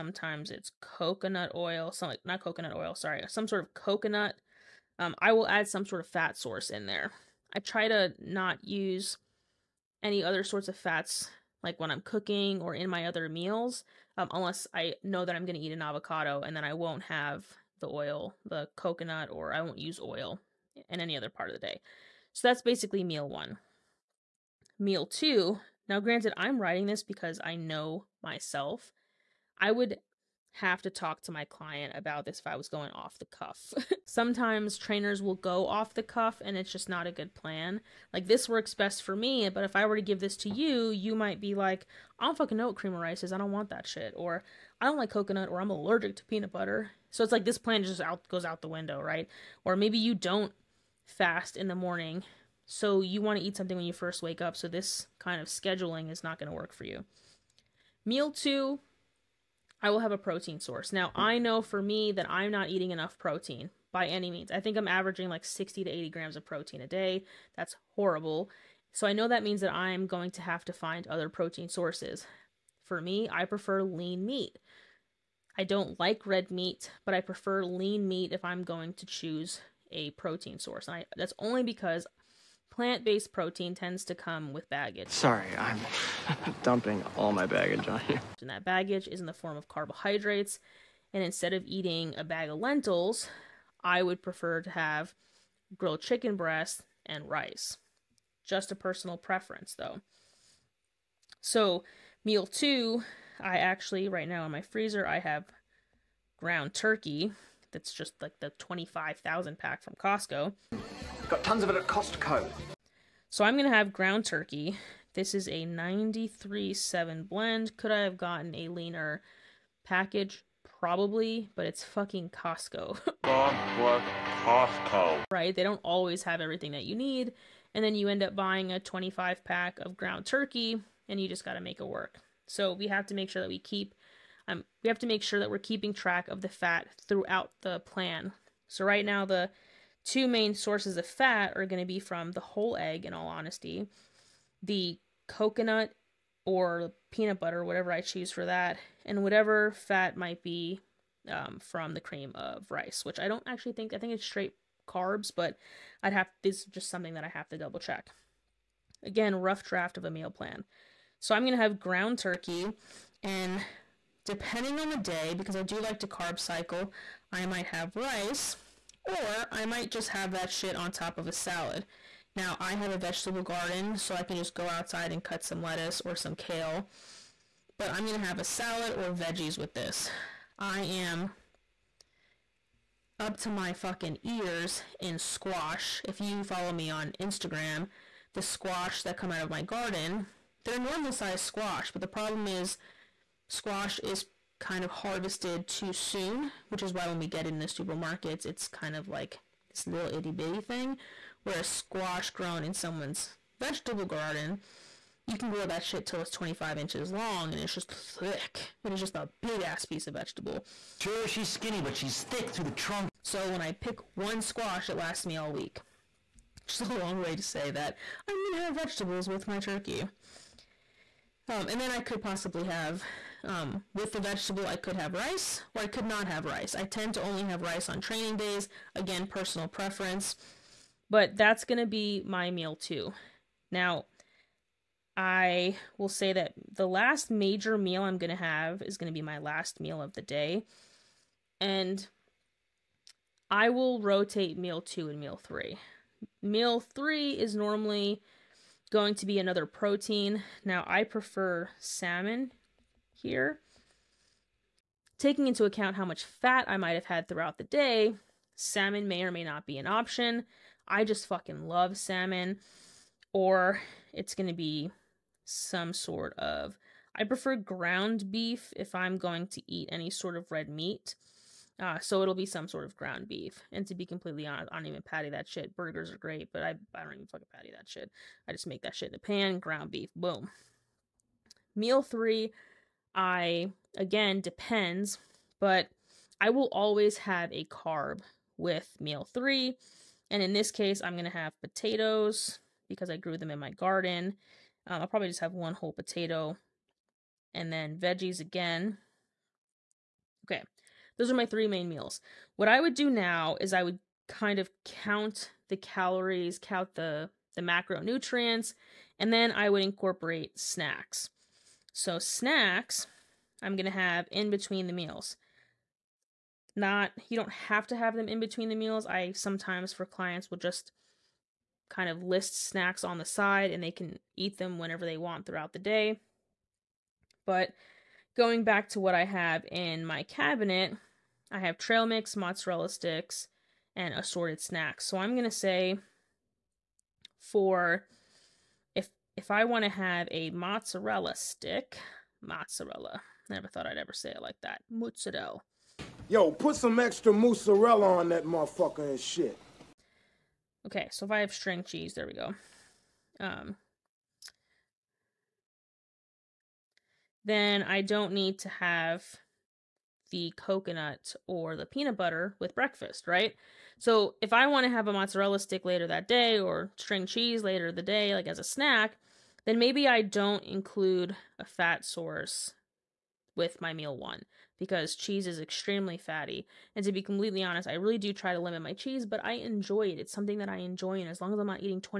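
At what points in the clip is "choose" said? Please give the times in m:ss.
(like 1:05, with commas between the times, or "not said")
1:19, 2:28.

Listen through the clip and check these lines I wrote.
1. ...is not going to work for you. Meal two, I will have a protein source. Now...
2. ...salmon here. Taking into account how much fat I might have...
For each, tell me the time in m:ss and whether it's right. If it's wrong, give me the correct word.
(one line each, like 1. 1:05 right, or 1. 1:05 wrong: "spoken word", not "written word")
1. 0:56 right
2. 4:11 right.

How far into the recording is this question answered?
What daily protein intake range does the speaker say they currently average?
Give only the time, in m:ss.
1:05.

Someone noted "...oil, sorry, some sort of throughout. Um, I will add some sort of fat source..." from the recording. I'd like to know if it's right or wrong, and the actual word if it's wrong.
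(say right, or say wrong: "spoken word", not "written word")
wrong: "coconut", not "throughout".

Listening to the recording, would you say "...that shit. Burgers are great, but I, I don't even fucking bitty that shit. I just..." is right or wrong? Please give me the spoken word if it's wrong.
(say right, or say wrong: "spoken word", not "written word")
wrong: "patty", not "bitty".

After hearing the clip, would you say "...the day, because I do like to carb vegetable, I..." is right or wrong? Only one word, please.
wrong.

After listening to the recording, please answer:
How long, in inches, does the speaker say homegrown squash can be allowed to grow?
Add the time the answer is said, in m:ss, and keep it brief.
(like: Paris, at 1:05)
25 inches, at 3:26.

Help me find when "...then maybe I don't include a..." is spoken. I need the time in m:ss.
6:09.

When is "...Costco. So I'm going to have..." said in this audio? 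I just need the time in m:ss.
1:51.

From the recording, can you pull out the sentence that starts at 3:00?
I am up to my fucking ears in squash.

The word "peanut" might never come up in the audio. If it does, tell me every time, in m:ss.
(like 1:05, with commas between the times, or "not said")
0:46, 2:27, 6:01.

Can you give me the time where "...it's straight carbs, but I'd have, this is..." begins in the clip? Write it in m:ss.
2:34.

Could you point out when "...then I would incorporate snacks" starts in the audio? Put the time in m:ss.
5:09.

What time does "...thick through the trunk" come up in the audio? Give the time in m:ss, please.
3:32.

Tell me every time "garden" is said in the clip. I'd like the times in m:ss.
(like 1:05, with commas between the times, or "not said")
2:53, 3:09, 3:24, 4:53.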